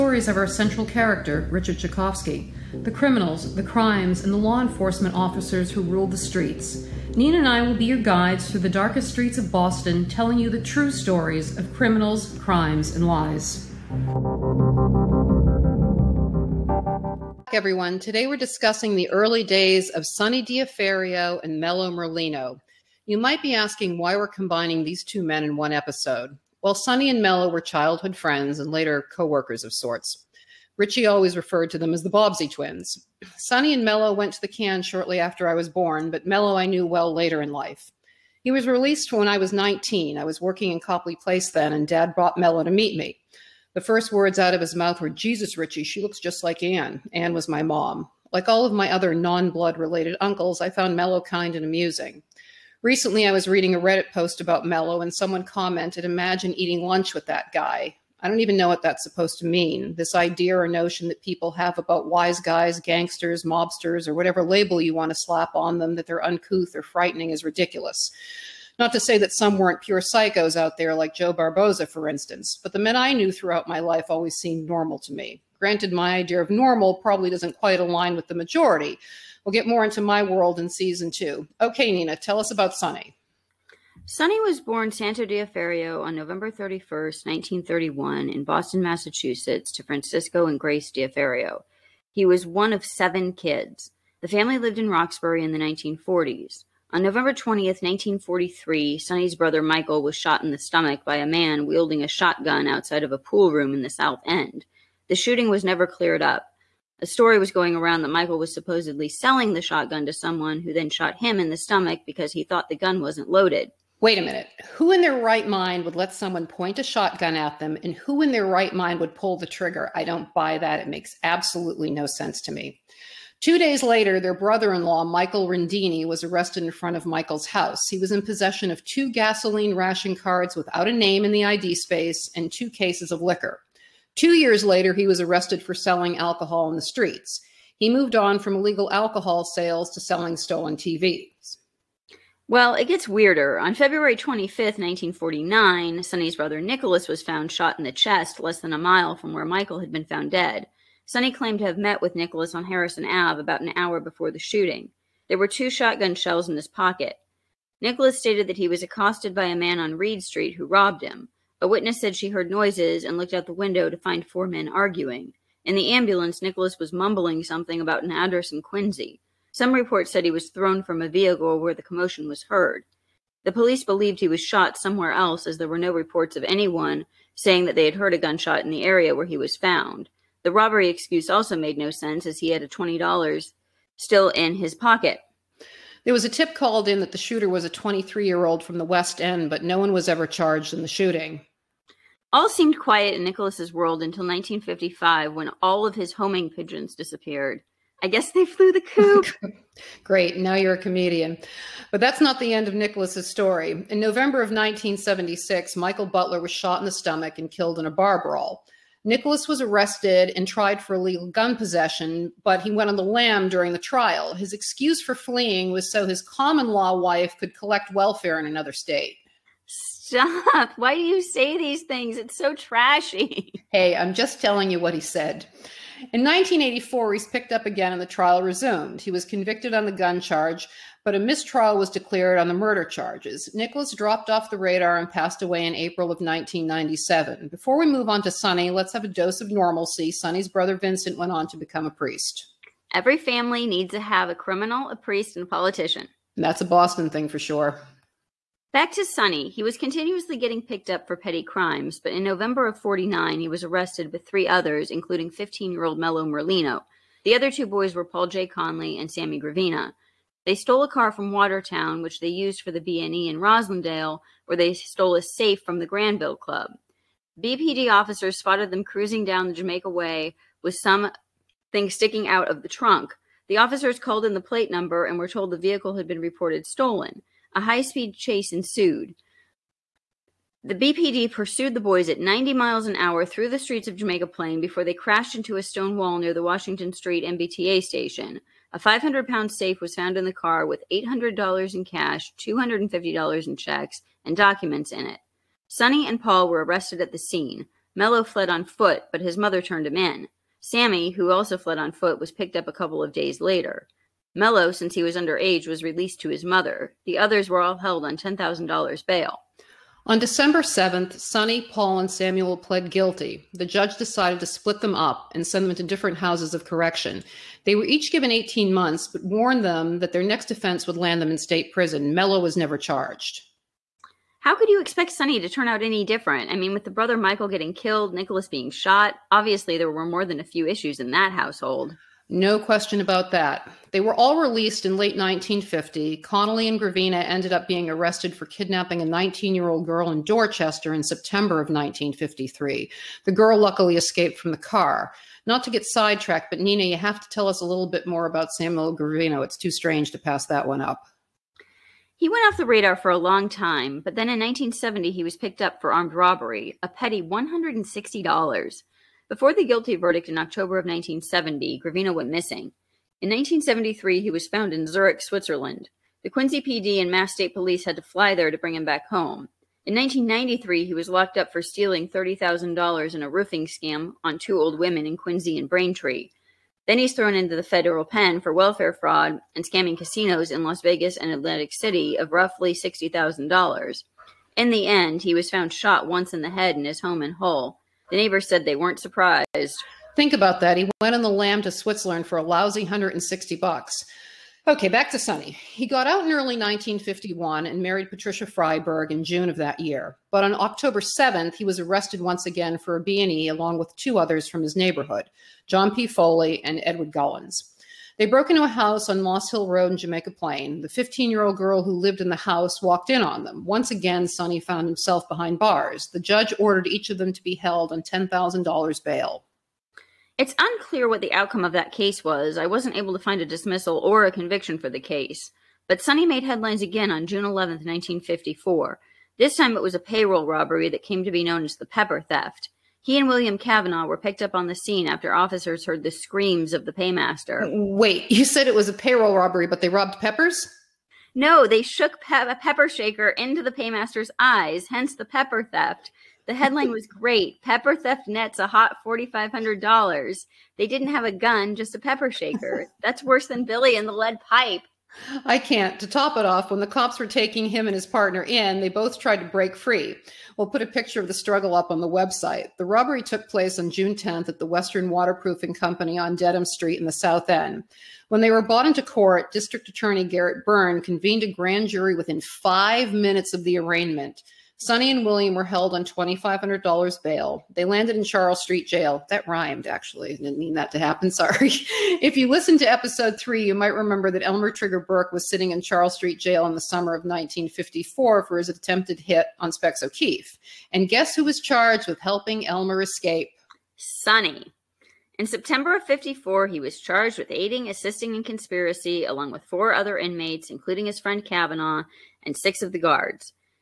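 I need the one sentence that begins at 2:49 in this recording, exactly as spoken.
Some reports said he was thrown from a vehicle where the commotion was heard.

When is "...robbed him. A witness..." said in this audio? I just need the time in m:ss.
2:40.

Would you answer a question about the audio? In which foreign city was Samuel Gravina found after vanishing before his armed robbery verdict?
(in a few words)
Zurich.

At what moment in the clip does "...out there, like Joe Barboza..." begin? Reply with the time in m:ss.
1:10.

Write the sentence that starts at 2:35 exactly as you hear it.
There were two shotgun shells in his pocket.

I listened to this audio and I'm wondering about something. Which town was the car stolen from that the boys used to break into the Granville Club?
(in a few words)
Watertown.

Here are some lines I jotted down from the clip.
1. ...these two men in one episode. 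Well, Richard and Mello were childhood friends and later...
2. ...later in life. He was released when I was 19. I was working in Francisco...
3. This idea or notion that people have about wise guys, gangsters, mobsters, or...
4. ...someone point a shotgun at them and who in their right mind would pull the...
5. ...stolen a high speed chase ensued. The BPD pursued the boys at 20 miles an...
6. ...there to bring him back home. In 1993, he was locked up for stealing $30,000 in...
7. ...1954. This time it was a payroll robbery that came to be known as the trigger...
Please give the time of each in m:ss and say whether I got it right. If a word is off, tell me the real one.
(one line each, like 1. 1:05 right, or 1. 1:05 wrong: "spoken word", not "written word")
1. 0:24 wrong: "Sonny", not "Richard"
2. 0:37 wrong: "Copley", not "Francisco"
3. 0:59 right
4. 1:56 right
5. 4:36 wrong: "90", not "20"
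6. 6:08 right
7. 7:07 wrong: "pepper", not "trigger".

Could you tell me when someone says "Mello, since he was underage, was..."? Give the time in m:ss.
5:04.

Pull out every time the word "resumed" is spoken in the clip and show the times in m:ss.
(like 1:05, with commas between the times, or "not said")
3:48.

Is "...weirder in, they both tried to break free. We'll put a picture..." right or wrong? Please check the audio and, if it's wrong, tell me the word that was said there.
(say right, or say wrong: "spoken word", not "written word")
wrong: "partner", not "weirder".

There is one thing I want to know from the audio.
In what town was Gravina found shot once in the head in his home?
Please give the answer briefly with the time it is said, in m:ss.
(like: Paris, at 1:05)
Hull, at 6:27.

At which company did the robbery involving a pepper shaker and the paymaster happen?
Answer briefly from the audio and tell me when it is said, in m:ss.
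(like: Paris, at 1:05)
Western Waterproofing Company, at 7:44.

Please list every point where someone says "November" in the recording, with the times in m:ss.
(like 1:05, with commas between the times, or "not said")
1:26, 1:37, 3:23, 4:12.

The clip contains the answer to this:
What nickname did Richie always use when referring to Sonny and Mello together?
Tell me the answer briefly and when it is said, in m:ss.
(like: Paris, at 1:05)
the Bobbsey twins, at 0:32.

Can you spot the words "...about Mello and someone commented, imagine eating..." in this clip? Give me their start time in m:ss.
0:54.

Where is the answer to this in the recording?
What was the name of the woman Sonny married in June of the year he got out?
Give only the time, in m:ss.
6:38.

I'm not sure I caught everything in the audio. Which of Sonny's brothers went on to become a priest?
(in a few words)
Vincent.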